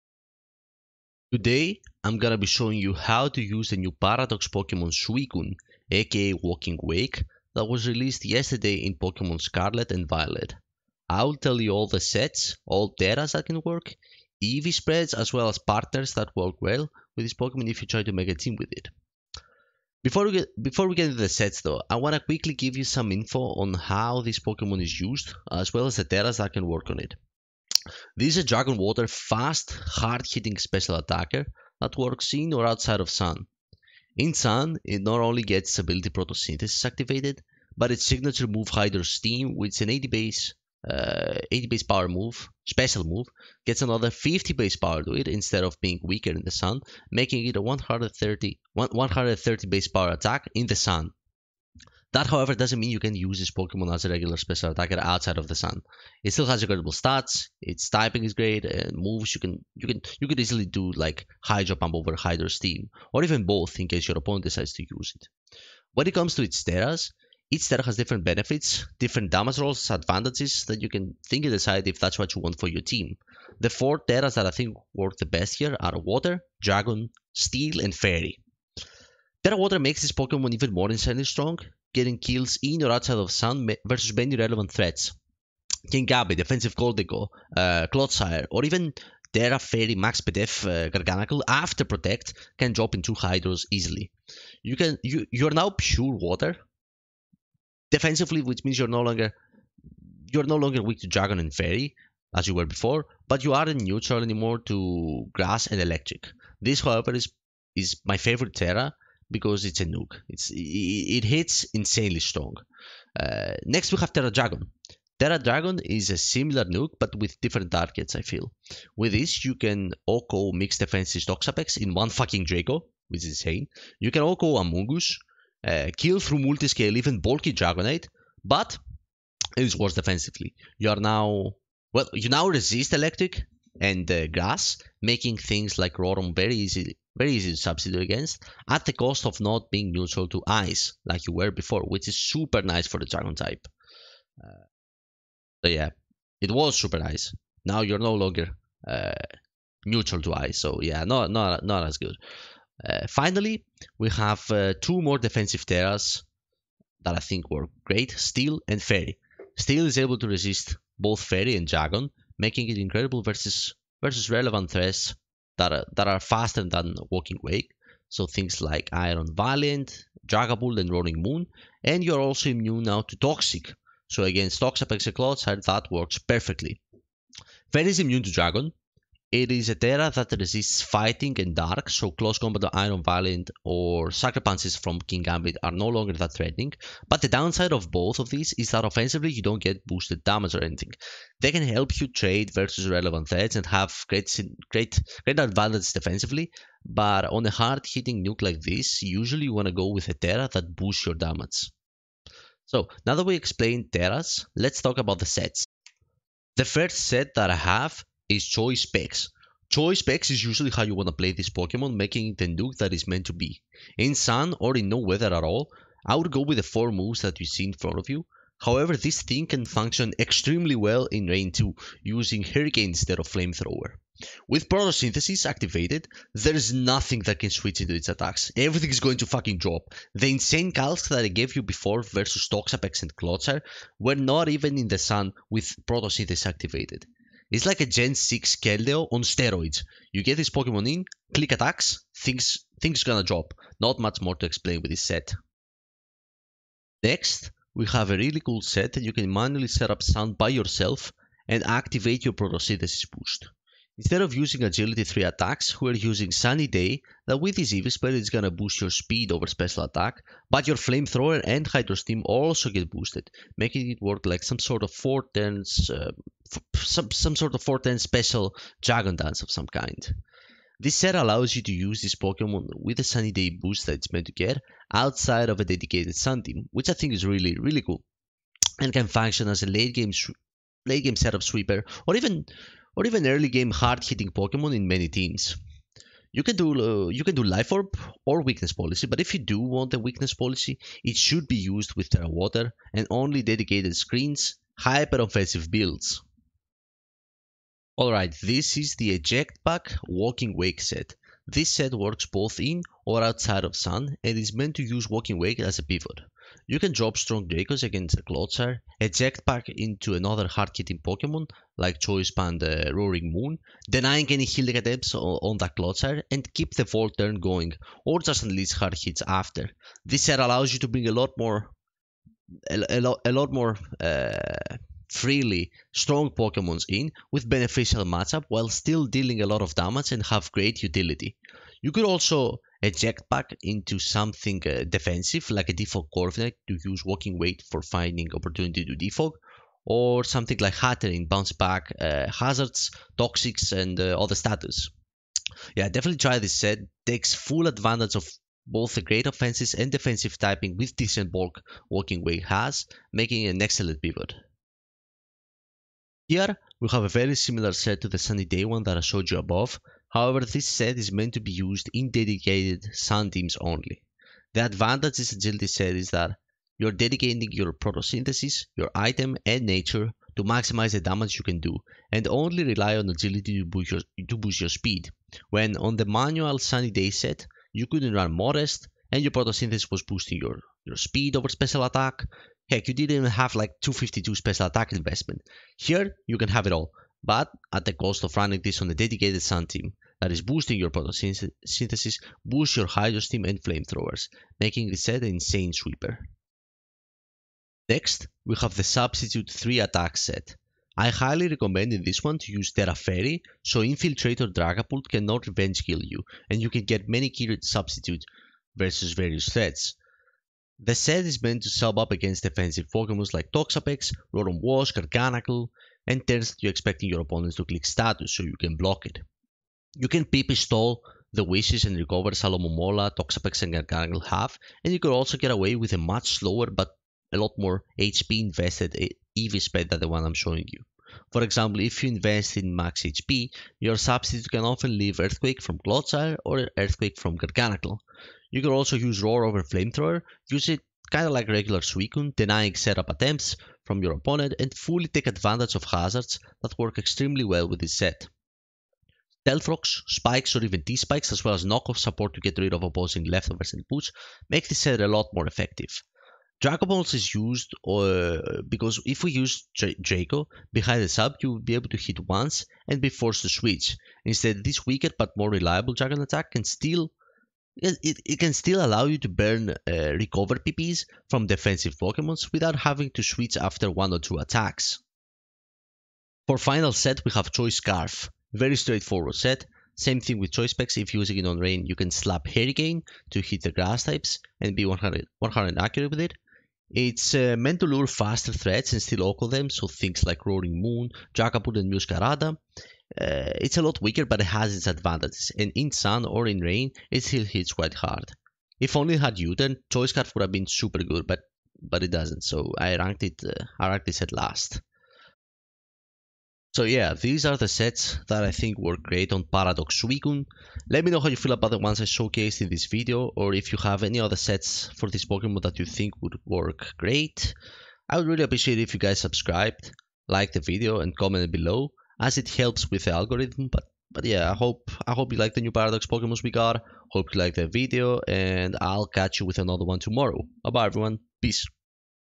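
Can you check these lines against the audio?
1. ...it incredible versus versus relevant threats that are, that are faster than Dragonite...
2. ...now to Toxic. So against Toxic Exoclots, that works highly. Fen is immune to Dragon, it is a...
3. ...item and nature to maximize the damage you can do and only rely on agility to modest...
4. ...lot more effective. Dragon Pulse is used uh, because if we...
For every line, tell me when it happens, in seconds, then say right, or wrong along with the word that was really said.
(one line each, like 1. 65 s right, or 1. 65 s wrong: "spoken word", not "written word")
1. 162 s wrong: "Walking", not "Dragonite"
2. 172 s wrong: "perfectly", not "highly"
3. 368 s wrong: "boost", not "modest"
4. 455 s right.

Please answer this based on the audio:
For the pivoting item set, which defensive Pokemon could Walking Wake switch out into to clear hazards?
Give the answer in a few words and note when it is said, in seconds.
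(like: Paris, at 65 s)
Corviknight, at 336 s.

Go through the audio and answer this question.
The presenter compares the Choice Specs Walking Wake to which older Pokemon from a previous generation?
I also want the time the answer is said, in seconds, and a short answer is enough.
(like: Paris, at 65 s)
Keldeo, at 238 s.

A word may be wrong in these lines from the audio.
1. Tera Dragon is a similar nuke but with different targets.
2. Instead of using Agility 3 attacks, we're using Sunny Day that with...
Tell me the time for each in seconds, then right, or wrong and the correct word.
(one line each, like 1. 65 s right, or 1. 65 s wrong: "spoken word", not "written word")
1. 115 s right
2. 253 s right.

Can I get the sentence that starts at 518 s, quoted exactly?
I would really appreciate if you guys subscribed, like the video and comment below as it helps with the algorithm.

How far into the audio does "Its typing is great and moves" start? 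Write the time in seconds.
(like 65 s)
57 s.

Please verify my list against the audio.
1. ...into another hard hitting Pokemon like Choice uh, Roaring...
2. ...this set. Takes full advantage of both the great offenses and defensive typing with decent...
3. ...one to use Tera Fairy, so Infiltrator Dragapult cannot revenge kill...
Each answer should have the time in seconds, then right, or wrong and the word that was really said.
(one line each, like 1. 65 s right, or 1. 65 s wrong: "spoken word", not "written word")
1. 309 s right
2. 346 s right
3. 402 s right.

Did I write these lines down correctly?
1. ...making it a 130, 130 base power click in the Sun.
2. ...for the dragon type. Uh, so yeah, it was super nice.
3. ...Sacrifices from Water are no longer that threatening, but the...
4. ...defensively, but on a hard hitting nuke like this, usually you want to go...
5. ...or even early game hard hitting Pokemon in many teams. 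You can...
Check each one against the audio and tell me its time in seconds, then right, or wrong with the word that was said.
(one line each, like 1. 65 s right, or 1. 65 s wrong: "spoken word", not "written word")
1. 47 s wrong: "attack", not "click"
2. 142 s right
3. 184 s wrong: "Kingambit", not "Water"
4. 195 s right
5. 282 s right.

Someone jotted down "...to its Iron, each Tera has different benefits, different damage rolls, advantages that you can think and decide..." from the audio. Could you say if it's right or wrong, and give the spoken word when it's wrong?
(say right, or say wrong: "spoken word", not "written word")
wrong: "Teras", not "Iron".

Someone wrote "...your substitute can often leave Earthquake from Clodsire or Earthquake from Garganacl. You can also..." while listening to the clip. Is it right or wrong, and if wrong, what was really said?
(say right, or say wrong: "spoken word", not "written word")
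right.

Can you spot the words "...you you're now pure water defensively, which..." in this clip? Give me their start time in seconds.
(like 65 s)
95 s.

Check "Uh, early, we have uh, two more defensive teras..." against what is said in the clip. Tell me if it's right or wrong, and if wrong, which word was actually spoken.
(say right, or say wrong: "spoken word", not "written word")
wrong: "finally", not "early".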